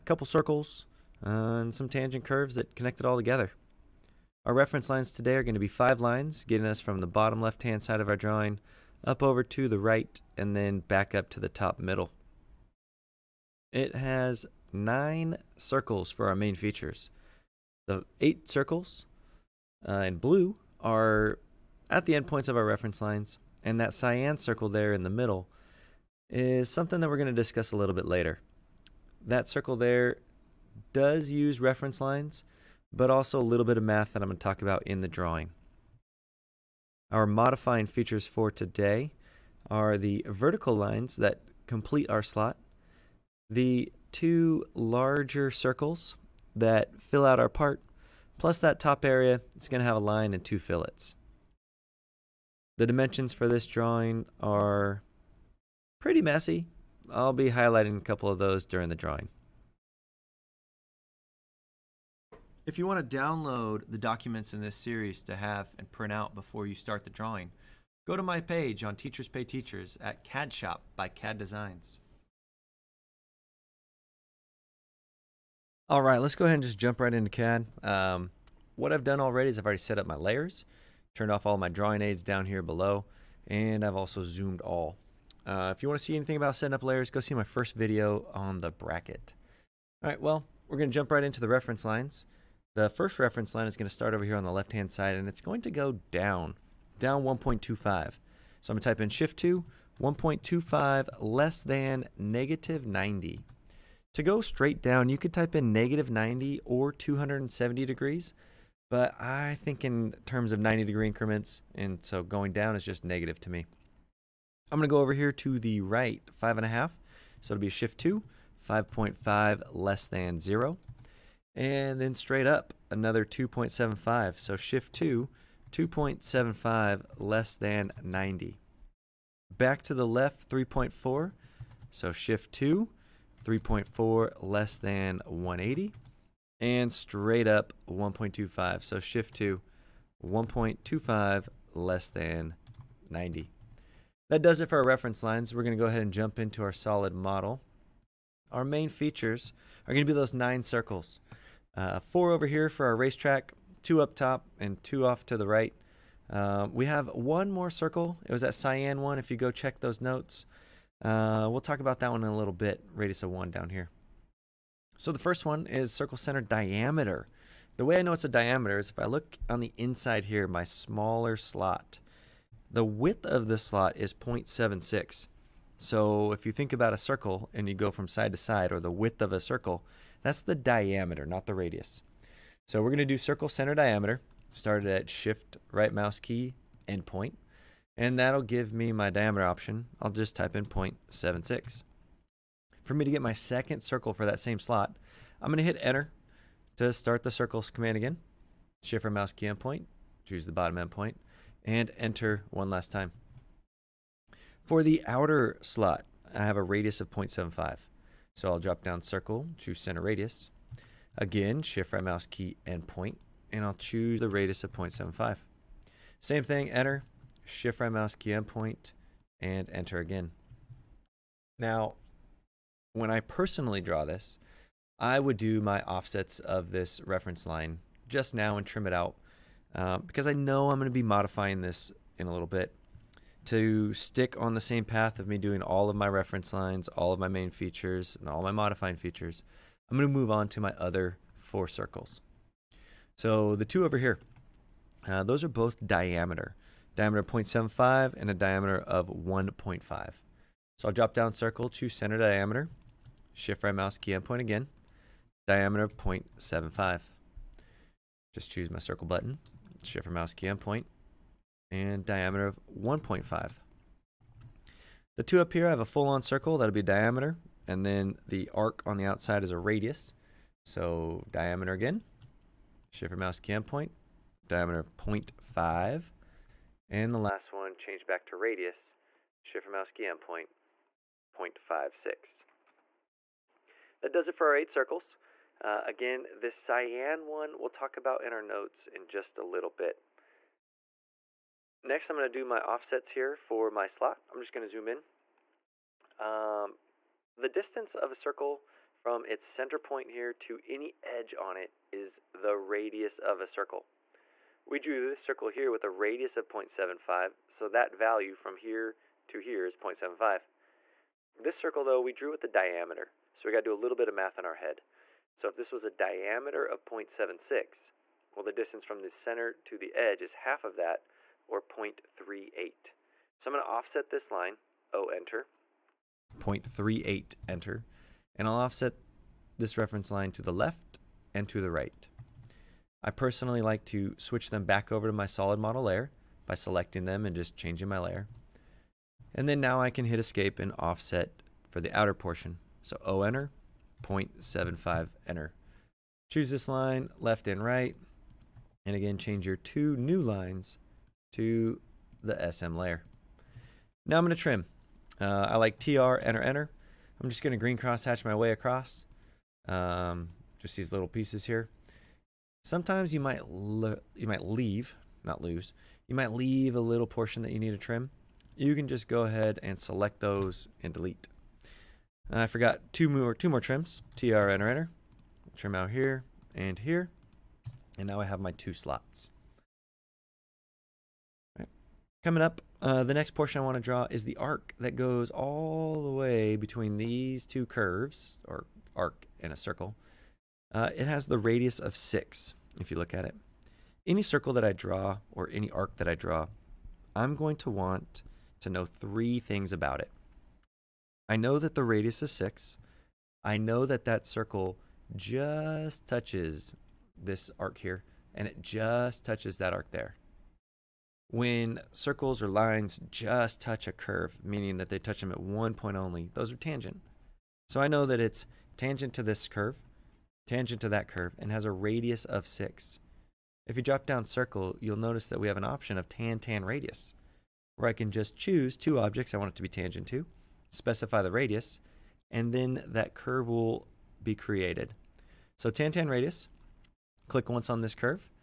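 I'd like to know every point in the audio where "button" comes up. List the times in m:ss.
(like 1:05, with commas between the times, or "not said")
4:19.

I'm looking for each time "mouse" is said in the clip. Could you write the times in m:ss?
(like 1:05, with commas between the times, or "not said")
3:05, 3:19, 3:32, 3:37, 4:13, 4:20, 4:33, 4:39.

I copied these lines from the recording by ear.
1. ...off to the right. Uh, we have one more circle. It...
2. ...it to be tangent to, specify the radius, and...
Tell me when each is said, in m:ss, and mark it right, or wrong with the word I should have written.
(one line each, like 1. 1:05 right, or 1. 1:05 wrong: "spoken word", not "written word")
1. 2:35 right
2. 7:09 right.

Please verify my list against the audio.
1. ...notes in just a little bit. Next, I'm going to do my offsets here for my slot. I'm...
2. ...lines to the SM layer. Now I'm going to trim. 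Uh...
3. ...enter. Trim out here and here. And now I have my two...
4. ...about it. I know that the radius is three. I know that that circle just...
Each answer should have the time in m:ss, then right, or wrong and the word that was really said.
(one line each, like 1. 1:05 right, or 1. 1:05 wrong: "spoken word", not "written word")
1. 4:48 right
2. 5:50 right
3. 6:14 right
4. 6:39 wrong: "six", not "three".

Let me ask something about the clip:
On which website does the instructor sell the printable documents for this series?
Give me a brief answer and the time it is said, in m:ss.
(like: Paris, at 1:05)
Teachers Pay Teachers, at 1:08.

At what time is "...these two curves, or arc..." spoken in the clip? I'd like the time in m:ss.
6:26.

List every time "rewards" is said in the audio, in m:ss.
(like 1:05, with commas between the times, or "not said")
not said.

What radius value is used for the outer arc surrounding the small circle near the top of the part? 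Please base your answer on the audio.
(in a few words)
0.56.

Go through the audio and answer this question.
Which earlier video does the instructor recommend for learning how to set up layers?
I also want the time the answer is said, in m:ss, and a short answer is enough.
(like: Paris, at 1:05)
the bracket, at 1:28.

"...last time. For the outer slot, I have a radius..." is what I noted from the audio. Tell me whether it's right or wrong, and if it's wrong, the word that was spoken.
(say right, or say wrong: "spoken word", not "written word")
right.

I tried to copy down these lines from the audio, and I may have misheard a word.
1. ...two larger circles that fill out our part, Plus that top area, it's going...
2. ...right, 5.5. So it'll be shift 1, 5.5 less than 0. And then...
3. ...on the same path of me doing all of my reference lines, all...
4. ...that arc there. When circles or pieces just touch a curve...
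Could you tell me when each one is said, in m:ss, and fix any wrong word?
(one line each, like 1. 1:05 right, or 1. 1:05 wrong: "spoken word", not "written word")
1. 0:44 right
2. 1:55 wrong: "2", not "1"
3. 3:54 right
4. 6:49 wrong: "lines", not "pieces".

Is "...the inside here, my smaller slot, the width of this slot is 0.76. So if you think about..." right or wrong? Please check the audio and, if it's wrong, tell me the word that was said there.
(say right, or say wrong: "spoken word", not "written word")
right.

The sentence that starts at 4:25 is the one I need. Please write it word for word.
The two up here, I have a full-on circle, that'll be diameter, and then the arc on the outside is a radius.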